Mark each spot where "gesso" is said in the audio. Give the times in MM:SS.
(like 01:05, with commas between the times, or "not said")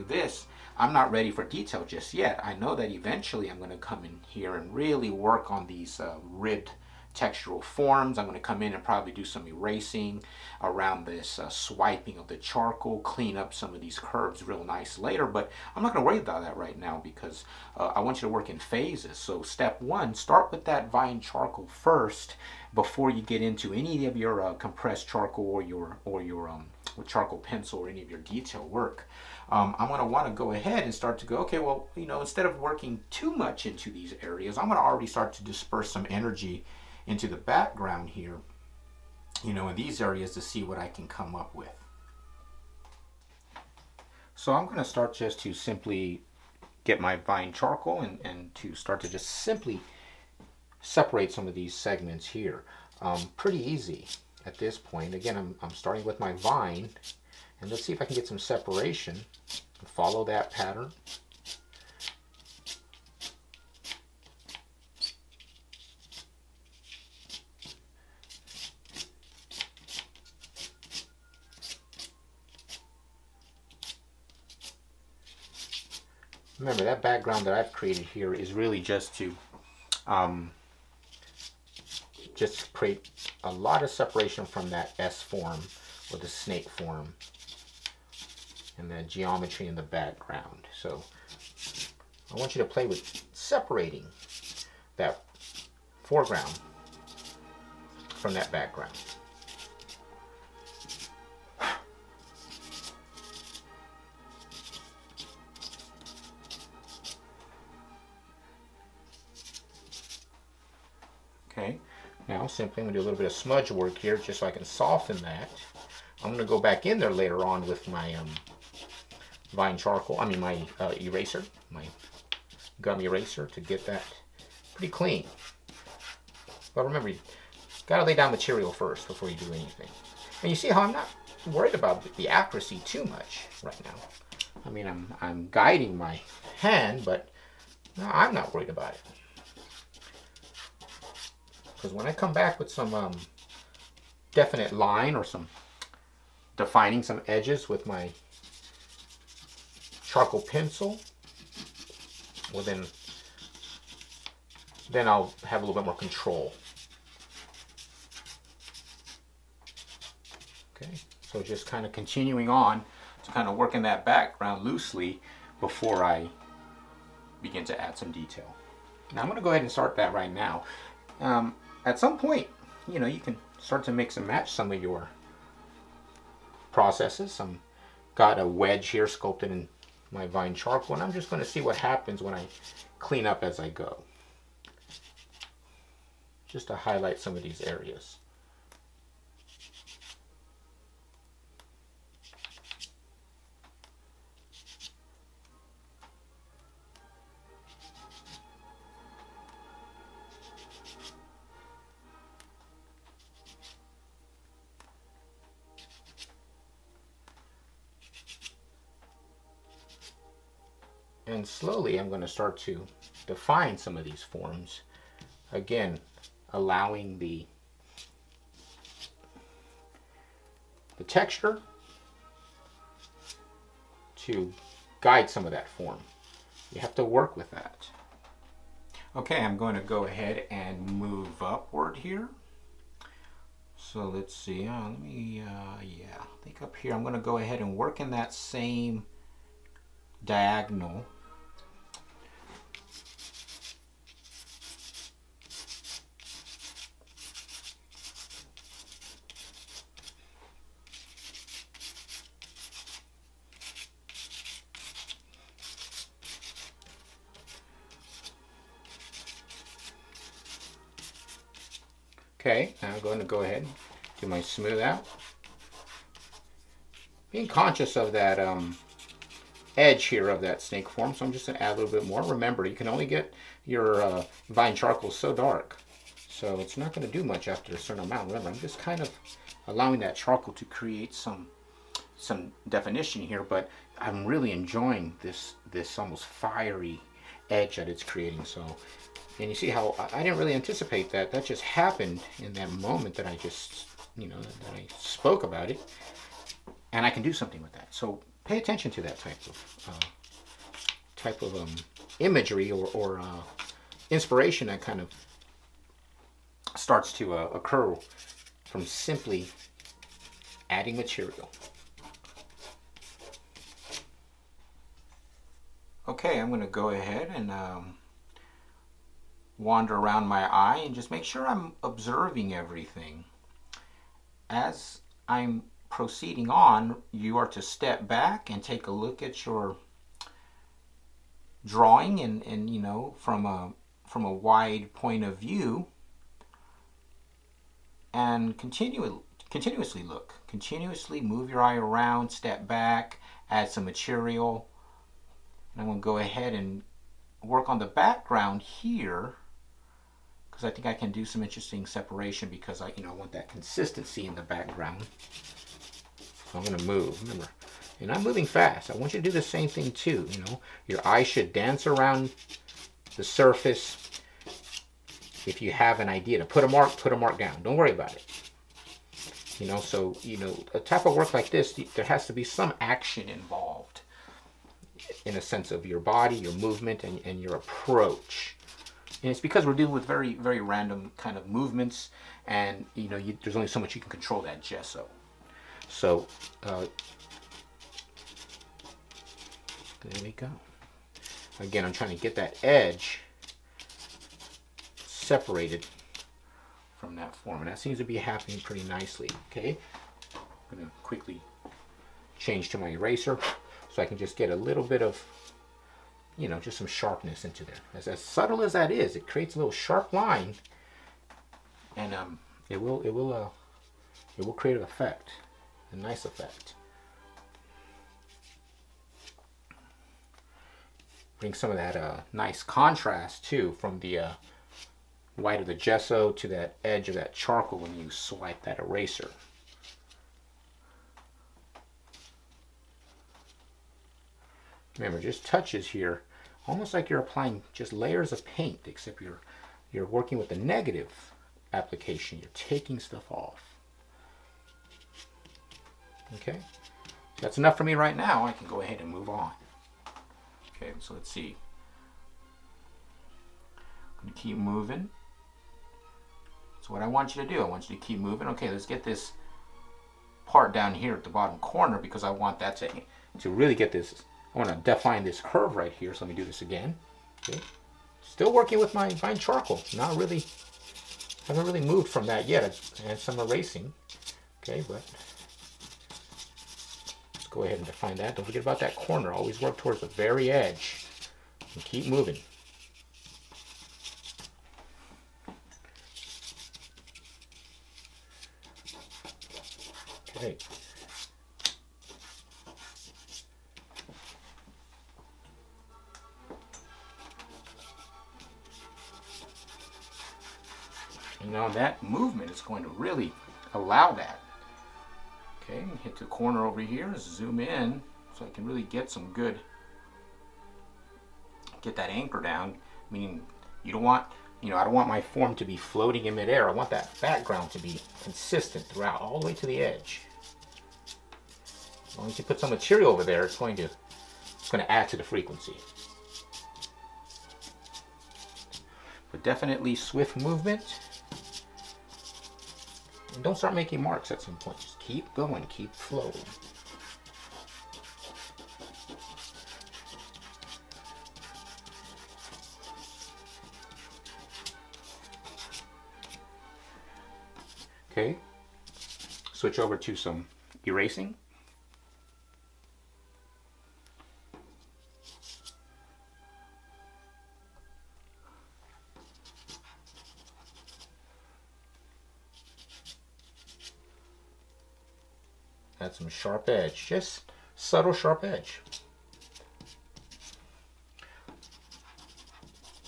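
06:24, 07:05.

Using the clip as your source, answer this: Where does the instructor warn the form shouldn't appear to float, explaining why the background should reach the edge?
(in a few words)
midair.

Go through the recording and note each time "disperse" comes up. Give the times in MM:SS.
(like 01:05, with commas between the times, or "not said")
00:35.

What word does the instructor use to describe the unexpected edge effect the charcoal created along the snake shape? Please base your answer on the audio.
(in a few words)
fiery.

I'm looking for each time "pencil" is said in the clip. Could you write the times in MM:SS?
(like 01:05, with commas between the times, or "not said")
00:27, 02:30.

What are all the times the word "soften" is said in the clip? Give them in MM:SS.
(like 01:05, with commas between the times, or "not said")
01:54.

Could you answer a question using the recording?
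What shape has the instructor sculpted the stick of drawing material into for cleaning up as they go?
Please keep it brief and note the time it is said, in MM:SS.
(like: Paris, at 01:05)
a wedge, at 02:58.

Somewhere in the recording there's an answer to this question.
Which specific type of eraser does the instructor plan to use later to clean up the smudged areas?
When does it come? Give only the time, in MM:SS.
02:02.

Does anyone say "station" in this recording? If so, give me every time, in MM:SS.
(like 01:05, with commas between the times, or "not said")
not said.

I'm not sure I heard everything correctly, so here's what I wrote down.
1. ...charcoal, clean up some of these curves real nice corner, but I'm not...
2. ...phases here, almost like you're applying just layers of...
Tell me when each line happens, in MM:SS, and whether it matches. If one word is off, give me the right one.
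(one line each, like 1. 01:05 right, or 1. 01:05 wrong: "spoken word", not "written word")
1. 00:12 wrong: "later", not "corner"
2. 07:15 wrong: "touches", not "phases".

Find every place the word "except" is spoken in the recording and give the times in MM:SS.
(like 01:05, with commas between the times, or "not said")
07:18.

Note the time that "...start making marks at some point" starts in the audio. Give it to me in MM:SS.
08:53.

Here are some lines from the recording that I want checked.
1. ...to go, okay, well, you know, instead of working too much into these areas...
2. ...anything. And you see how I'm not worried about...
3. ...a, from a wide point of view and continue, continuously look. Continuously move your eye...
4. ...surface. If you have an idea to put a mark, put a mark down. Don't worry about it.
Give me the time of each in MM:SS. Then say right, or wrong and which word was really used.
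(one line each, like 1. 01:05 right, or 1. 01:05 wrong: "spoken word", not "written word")
1. 00:31 right
2. 02:09 right
3. 05:33 right
4. 06:03 right.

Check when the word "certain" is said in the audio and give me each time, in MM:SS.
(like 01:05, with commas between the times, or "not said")
04:37.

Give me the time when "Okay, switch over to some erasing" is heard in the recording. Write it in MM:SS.
09:08.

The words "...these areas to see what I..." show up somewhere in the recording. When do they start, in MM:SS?
00:39.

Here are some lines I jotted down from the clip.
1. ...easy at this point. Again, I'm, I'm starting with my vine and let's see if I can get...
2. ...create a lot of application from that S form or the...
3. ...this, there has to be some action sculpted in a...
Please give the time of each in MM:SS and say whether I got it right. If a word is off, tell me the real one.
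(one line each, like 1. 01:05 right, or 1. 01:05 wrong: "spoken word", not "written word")
1. 00:53 right
2. 01:22 wrong: "separation", not "application"
3. 06:11 wrong: "involved", not "sculpted".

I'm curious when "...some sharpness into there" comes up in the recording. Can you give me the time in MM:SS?
06:46.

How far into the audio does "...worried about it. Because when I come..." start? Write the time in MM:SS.
02:18.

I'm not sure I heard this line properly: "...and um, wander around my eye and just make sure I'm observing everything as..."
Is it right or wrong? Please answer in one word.
right.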